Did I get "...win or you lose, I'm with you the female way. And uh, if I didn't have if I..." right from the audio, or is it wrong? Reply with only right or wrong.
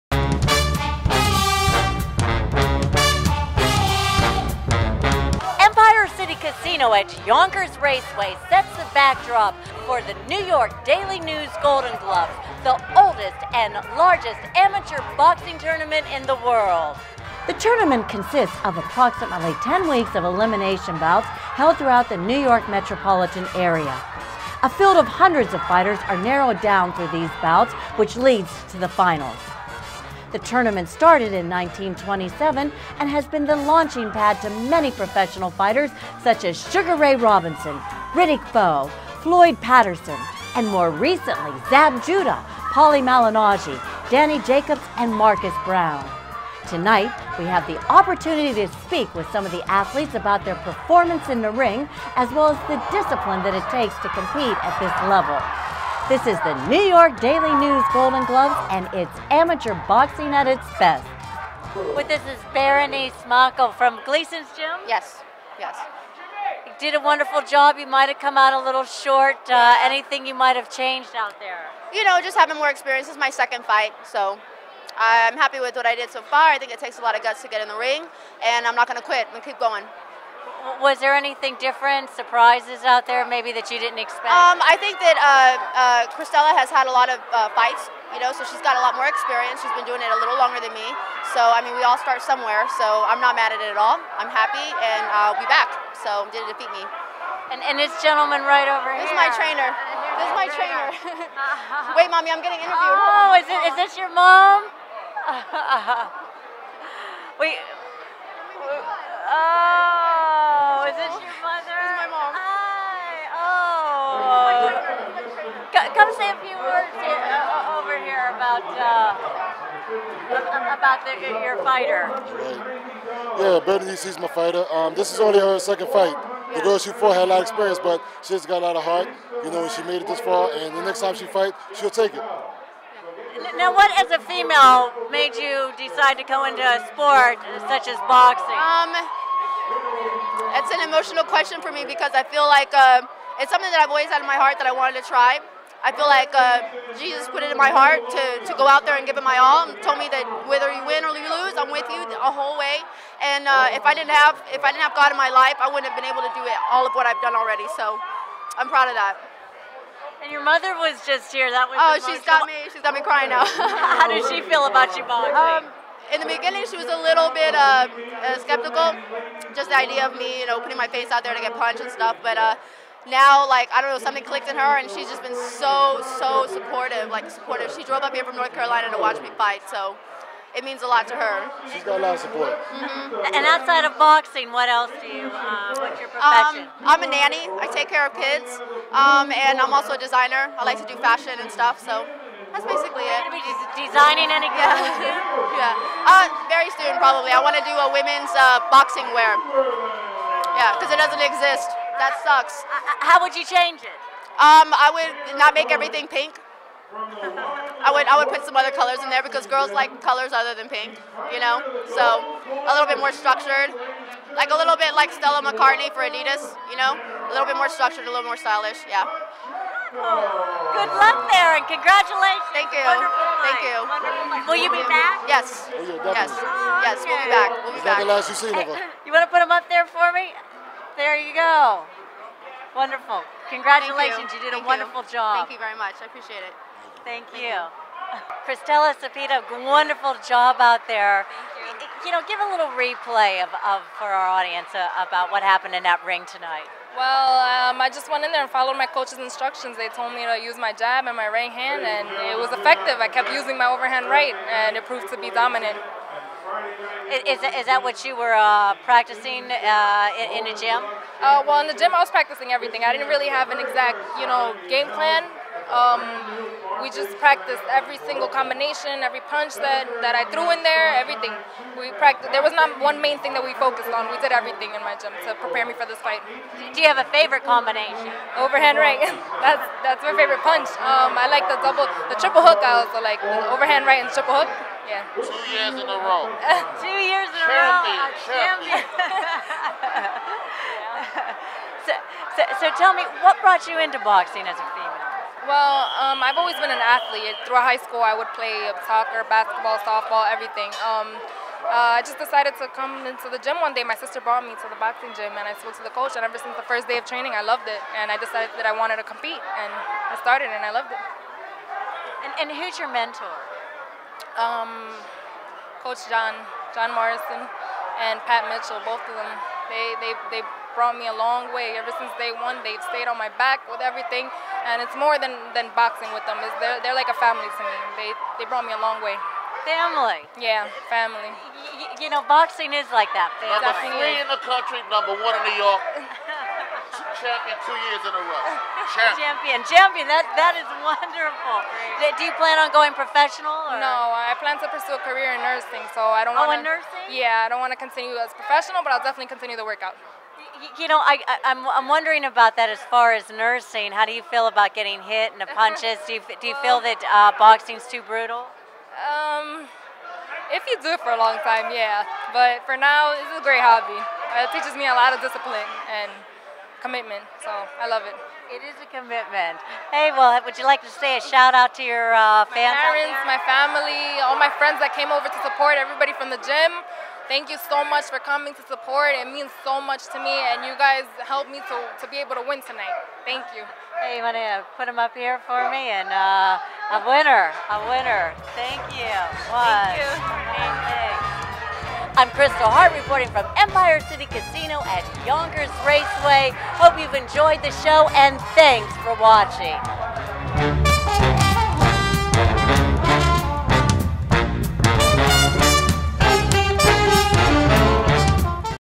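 wrong.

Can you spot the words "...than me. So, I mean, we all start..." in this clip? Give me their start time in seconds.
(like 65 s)
90 s.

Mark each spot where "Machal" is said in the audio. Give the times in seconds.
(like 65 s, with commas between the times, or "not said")
63 s.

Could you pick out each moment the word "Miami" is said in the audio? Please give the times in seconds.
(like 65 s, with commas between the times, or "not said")
not said.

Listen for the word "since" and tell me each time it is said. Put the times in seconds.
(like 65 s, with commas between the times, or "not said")
306 s, 321 s.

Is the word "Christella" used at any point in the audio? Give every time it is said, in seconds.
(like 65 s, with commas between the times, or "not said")
86 s, 238 s.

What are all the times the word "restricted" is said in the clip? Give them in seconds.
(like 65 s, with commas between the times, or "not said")
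not said.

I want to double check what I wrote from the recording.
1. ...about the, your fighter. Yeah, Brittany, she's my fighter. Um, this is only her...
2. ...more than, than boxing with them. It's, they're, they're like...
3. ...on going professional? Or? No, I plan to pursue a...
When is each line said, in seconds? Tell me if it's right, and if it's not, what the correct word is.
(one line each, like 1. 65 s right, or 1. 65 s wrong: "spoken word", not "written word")
1. 120 s right
2. 324 s right
3. 342 s right.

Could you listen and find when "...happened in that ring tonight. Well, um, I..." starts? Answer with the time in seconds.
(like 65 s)
245 s.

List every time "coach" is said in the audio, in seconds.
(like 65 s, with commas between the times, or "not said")
248 s, 305 s, 315 s.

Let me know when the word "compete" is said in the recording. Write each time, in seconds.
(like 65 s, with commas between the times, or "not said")
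54 s, 309 s.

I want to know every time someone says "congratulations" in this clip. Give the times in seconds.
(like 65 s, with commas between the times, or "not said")
221 s, 233 s.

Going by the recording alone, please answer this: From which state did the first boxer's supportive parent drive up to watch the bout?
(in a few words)
North Carolina.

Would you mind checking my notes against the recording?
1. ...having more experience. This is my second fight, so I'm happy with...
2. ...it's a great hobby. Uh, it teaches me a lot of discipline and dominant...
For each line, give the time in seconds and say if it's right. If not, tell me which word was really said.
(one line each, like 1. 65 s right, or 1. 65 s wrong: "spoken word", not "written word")
1. 72 s right
2. 363 s wrong: "commitment", not "dominant".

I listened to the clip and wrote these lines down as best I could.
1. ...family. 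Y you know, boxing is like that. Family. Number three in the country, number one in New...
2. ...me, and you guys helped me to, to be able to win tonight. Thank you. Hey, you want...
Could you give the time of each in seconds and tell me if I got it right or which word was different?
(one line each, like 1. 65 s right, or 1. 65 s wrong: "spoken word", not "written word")
1. 330 s right
2. 380 s right.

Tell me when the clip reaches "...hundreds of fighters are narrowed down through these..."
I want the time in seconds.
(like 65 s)
25 s.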